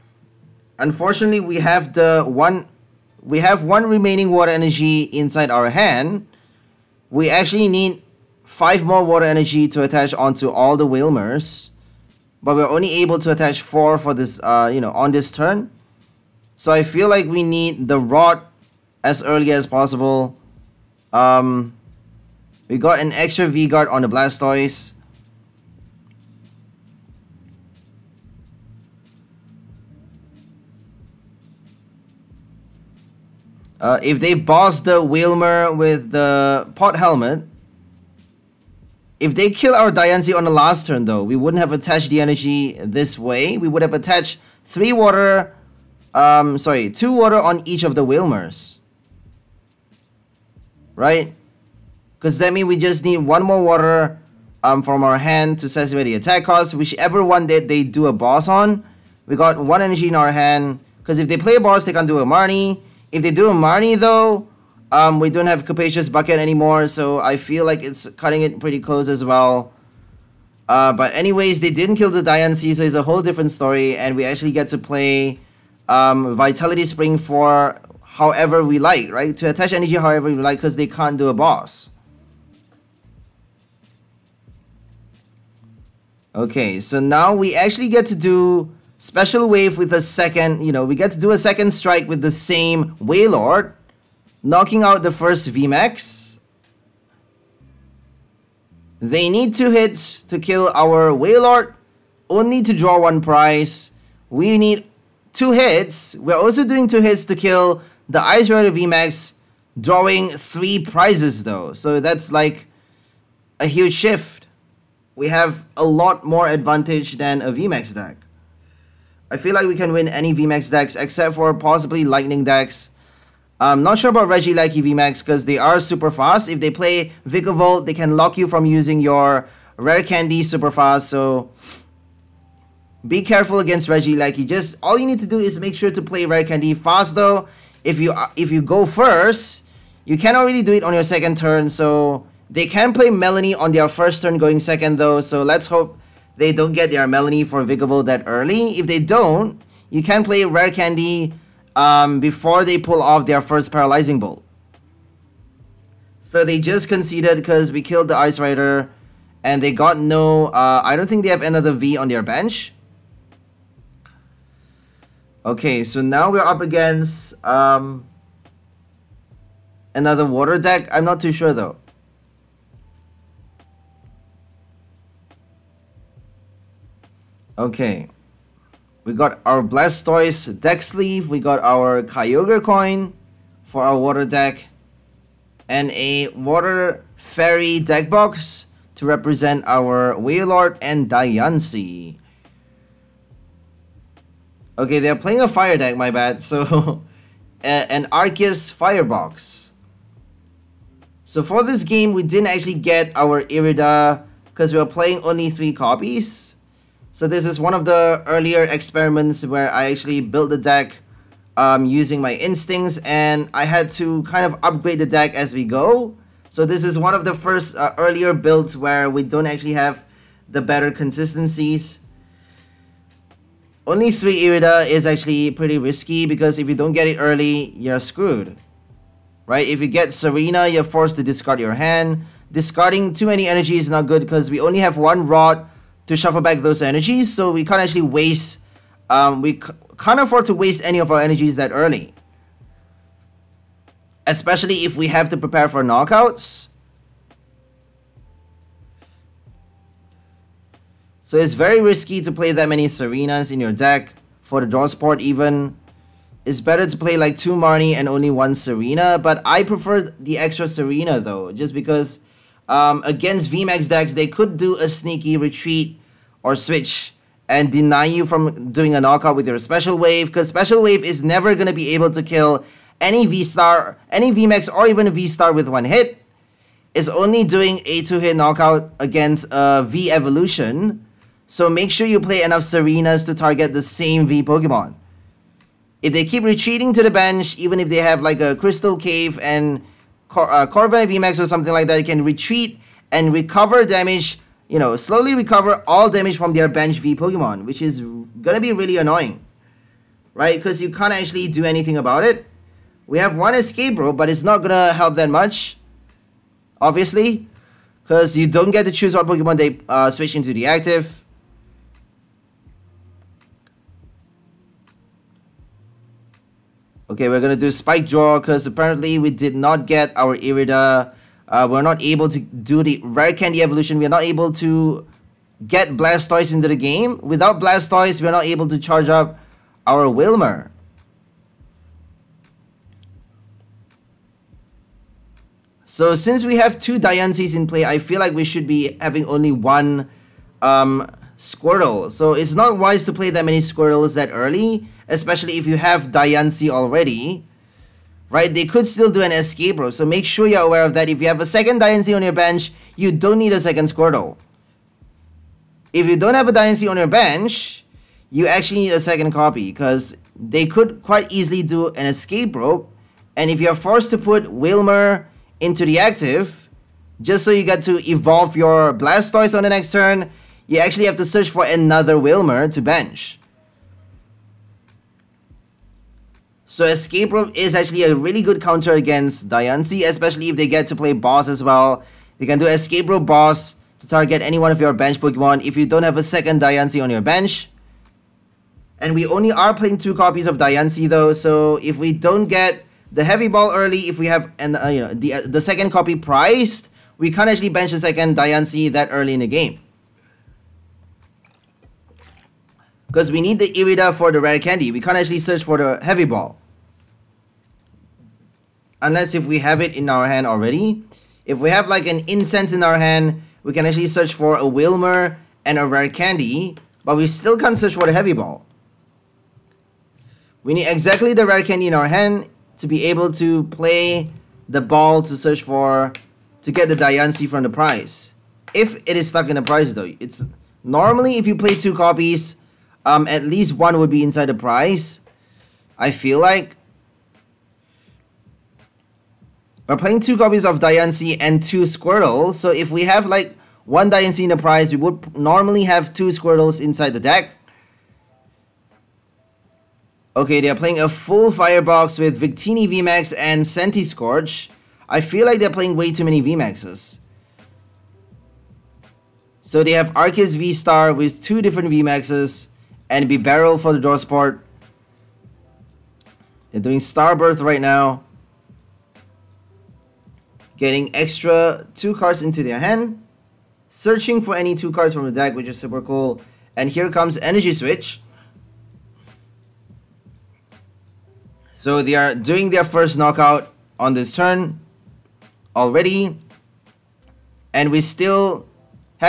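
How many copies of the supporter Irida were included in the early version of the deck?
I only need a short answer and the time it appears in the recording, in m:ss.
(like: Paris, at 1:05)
3, at 3:25.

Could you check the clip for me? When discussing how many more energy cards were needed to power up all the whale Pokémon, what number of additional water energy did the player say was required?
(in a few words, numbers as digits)
5.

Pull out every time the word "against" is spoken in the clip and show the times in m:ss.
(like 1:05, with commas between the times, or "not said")
2:13, 2:46, 4:23, 4:38, 6:18.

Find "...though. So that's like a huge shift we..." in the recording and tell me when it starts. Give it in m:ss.
1:51.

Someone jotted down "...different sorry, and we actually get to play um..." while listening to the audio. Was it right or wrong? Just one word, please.
wrong.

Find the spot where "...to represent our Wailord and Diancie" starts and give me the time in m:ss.
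3:08.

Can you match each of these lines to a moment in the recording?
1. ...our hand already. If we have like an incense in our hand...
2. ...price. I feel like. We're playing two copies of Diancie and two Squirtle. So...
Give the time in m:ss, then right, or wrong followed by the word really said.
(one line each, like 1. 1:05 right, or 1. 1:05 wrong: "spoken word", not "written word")
1. 6:50 right
2. 7:14 right.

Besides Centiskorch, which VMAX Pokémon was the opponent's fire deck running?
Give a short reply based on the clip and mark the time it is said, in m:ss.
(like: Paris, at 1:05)
Victini VMAX, at 7:32.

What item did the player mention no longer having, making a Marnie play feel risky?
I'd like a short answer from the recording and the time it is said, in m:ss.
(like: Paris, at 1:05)
Capacious Bucket, at 1:05.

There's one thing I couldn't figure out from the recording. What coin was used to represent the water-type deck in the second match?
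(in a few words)
Kyogre coin.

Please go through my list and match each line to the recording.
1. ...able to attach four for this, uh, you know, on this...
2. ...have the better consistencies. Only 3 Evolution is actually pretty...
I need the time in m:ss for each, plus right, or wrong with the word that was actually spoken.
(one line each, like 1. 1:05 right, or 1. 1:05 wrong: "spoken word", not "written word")
1. 0:13 right
2. 3:39 wrong: "Irida", not "Evolution".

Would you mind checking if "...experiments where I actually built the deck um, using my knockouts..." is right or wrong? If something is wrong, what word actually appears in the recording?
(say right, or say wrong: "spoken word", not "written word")
wrong: "instincts", not "knockouts".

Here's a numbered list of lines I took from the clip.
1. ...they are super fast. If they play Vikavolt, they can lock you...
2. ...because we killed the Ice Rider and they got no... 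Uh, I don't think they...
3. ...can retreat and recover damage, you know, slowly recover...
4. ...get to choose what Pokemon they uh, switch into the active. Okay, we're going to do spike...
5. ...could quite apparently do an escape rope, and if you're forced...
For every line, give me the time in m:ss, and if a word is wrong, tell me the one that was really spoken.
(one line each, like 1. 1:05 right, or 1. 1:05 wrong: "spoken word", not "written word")
1. 2:05 right
2. 2:37 right
3. 4:52 right
4. 5:08 right
5. 6:00 wrong: "easily", not "apparently".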